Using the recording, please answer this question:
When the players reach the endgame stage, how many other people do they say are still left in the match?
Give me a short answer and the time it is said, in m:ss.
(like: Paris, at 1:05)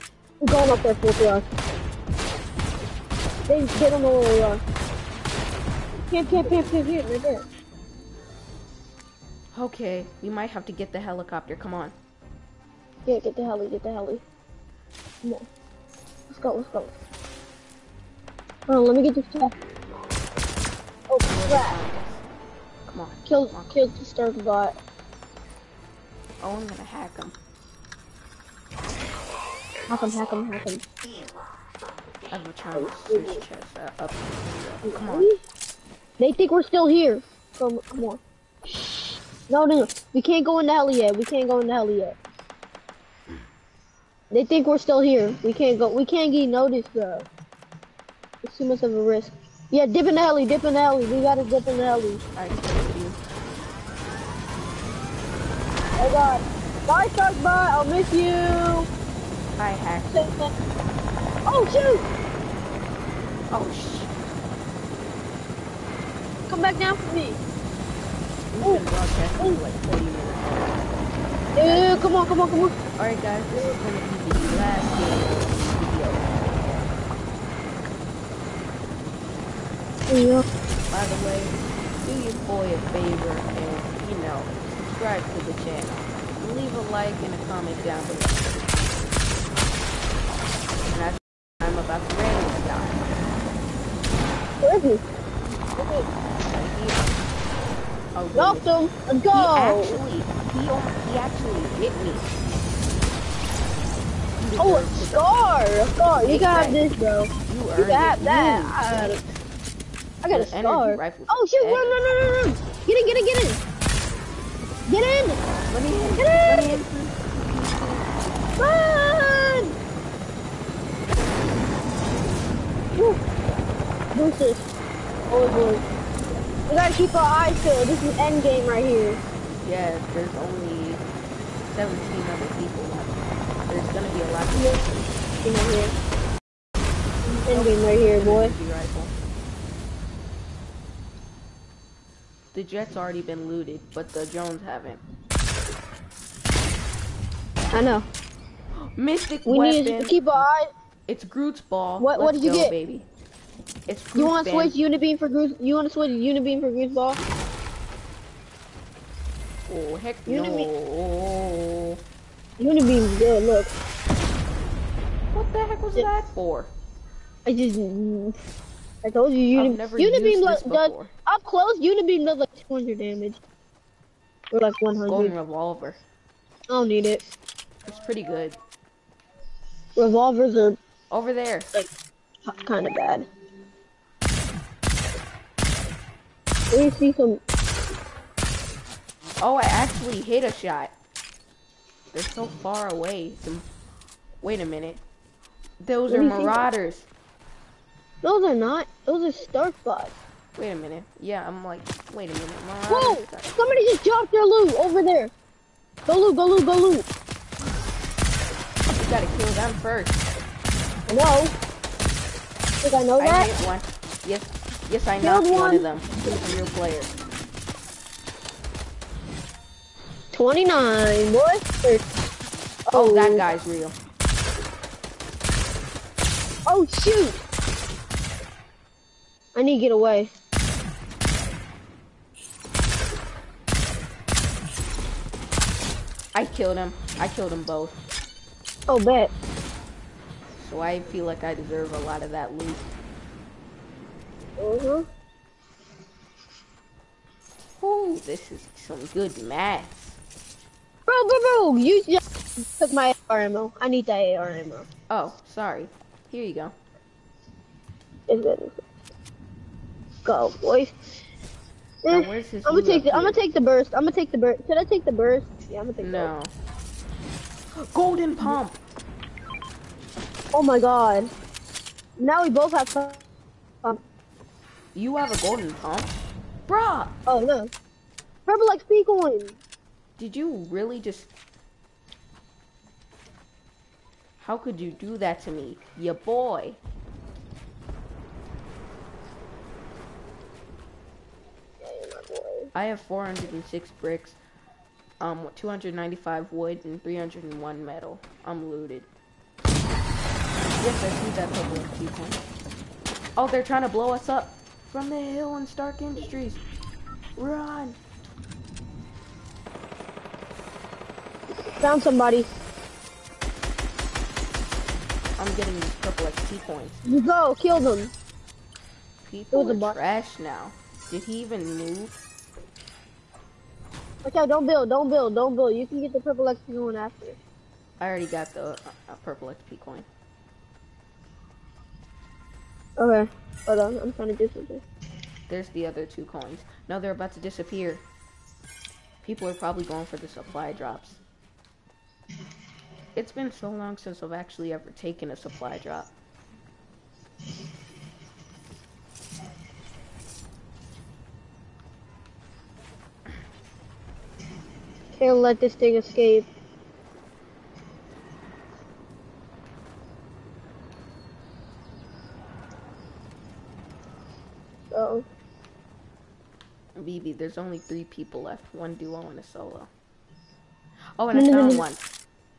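17, at 2:11.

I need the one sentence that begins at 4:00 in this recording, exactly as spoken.
So I feel like I deserve a lot of that loot.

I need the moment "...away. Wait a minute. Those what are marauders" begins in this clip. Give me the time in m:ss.
3:12.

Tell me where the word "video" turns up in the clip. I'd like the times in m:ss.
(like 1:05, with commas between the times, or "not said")
1:14.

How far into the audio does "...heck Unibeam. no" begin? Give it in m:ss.
2:39.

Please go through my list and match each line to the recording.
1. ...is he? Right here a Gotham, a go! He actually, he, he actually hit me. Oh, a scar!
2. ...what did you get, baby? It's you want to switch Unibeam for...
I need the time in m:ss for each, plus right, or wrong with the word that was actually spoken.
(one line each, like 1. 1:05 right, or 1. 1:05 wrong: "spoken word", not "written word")
1. 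1:34 right
2. 2:32 right.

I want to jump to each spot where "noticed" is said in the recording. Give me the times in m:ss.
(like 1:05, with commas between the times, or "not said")
0:46.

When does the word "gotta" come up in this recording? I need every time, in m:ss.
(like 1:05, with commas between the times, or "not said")
0:51, 2:06, 3:29.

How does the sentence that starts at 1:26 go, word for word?
Leave a like and a comment down below.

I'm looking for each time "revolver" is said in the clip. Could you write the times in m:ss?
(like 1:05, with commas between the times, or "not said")
2:55, 2:59.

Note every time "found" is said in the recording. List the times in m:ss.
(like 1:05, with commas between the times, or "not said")
5:11, 6:11.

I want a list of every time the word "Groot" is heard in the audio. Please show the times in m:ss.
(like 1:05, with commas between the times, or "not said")
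2:31.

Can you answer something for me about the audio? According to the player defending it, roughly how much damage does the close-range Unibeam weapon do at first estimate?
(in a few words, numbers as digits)
200.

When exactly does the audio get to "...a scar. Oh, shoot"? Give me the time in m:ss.
1:50.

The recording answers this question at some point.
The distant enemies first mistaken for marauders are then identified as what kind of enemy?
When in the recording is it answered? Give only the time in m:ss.
3:19.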